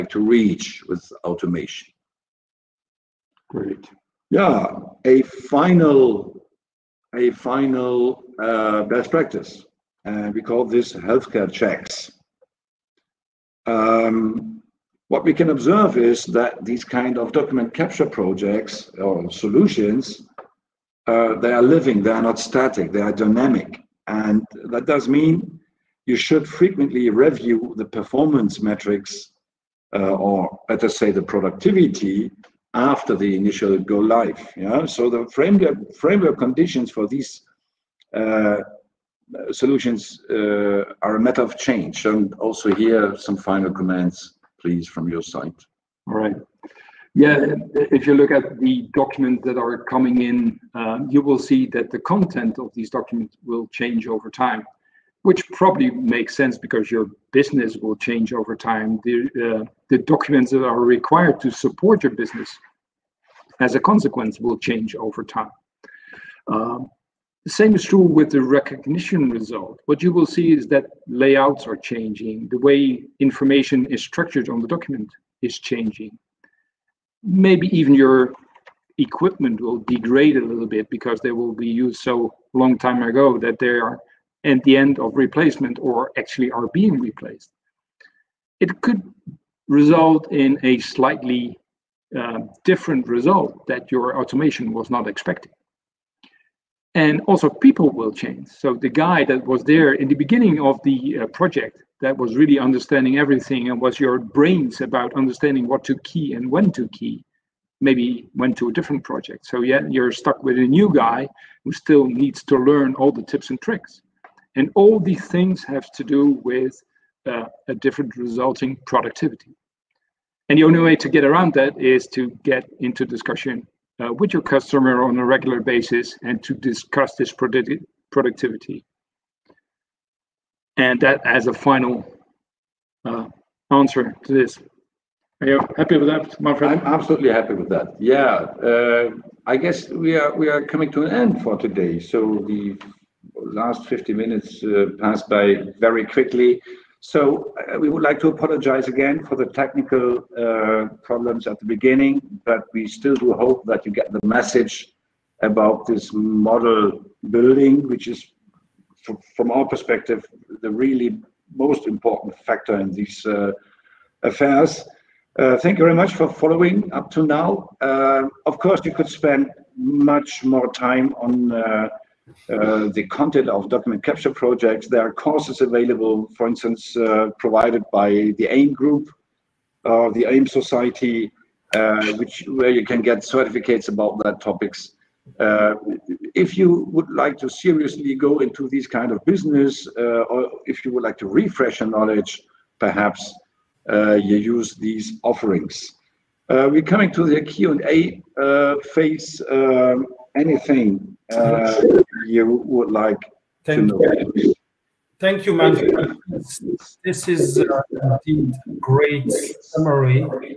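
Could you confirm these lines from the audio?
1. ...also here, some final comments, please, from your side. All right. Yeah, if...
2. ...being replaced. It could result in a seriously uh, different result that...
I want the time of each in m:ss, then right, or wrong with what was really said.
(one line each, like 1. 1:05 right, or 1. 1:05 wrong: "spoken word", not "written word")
1. 0:42 right
2. 1:26 wrong: "slightly", not "seriously".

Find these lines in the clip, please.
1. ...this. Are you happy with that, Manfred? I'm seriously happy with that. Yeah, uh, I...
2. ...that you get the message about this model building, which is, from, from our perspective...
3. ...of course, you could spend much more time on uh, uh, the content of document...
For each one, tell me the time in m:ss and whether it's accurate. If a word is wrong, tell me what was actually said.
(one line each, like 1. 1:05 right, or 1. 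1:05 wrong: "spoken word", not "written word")
1. 2:14 wrong: "absolutely", not "seriously"
2. 2:33 right
3. 2:48 right.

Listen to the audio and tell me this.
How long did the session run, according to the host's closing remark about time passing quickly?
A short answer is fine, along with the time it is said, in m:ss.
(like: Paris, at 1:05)
50 minutes, at 2:23.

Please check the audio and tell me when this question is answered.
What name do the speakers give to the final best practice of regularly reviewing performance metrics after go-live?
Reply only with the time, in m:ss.
0:10.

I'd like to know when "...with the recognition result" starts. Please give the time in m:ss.
1:07.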